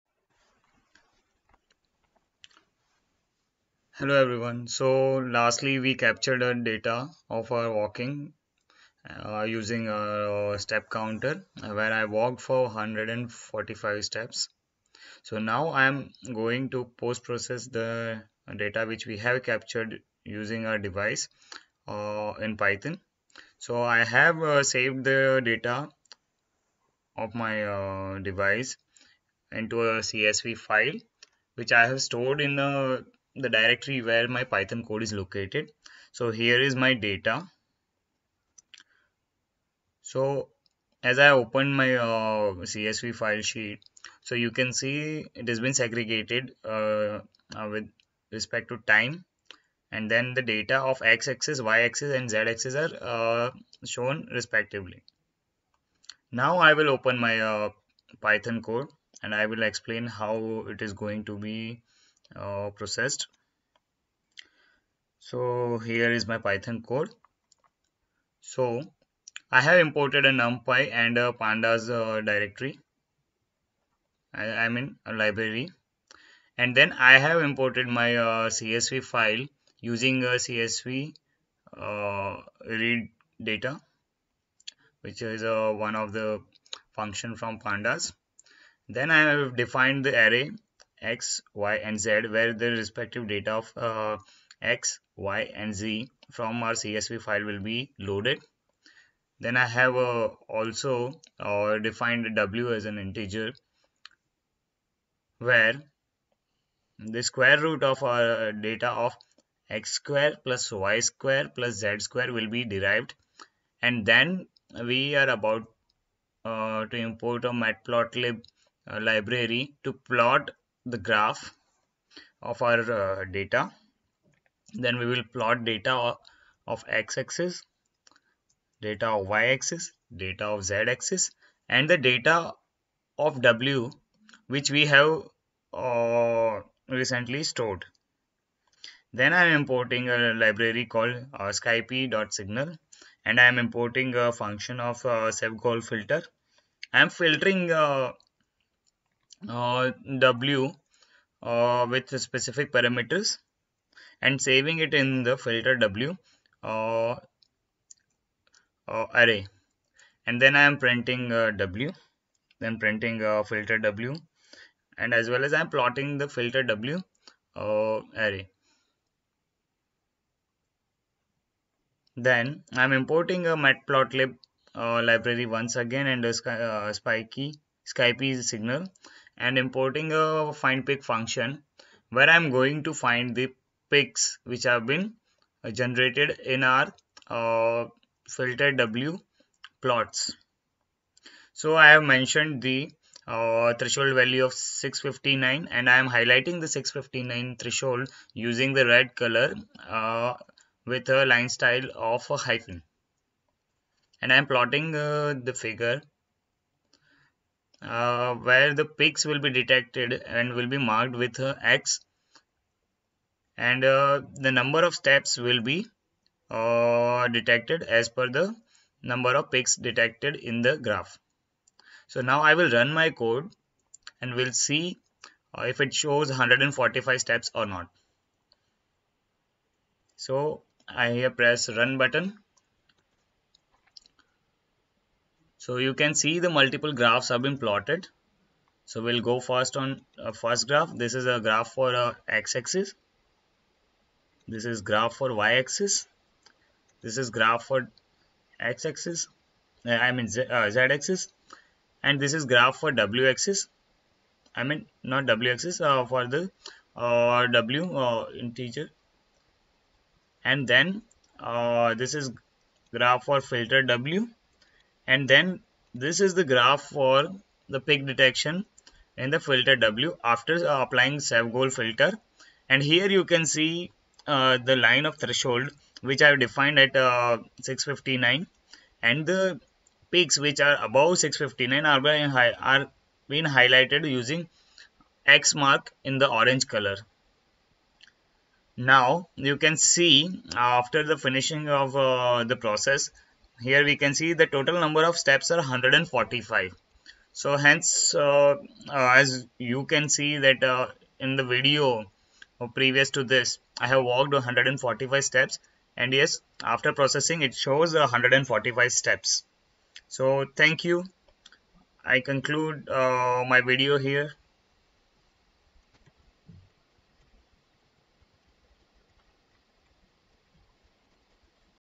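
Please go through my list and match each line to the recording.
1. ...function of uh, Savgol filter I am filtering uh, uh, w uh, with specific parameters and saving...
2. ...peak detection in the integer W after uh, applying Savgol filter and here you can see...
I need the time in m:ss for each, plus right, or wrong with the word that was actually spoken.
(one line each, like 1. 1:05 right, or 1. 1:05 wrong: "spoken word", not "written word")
1. 2:24 right
2. 4:27 wrong: "filter", not "integer".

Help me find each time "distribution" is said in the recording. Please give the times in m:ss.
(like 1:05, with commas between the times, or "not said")
not said.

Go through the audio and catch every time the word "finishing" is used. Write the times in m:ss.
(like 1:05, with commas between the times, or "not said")
4:51.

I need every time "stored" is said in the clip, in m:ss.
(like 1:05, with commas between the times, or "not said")
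0:32, 2:17.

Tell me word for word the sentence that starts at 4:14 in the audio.
I mean not w-axis uh, for the uh, w uh, integer.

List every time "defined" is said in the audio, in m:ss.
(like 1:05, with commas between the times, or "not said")
1:29, 1:41, 4:36.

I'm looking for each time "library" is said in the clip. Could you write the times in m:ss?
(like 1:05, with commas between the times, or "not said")
1:15, 1:59, 2:20, 2:54.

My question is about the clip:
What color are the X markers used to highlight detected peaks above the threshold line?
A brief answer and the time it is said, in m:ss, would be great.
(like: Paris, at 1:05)
orange, at 4:46.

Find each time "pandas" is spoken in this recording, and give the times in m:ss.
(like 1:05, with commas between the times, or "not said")
1:11, 1:27.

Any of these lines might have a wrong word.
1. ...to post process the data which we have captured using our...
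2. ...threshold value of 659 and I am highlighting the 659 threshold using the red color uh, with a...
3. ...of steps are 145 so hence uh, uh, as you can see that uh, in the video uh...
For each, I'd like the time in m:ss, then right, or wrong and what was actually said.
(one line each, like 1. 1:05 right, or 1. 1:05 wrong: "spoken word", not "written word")
1. 0:16 right
2. 3:13 right
3. 4:55 right.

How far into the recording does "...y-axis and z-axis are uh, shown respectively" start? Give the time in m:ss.
0:51.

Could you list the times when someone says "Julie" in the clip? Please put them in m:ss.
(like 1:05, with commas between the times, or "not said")
not said.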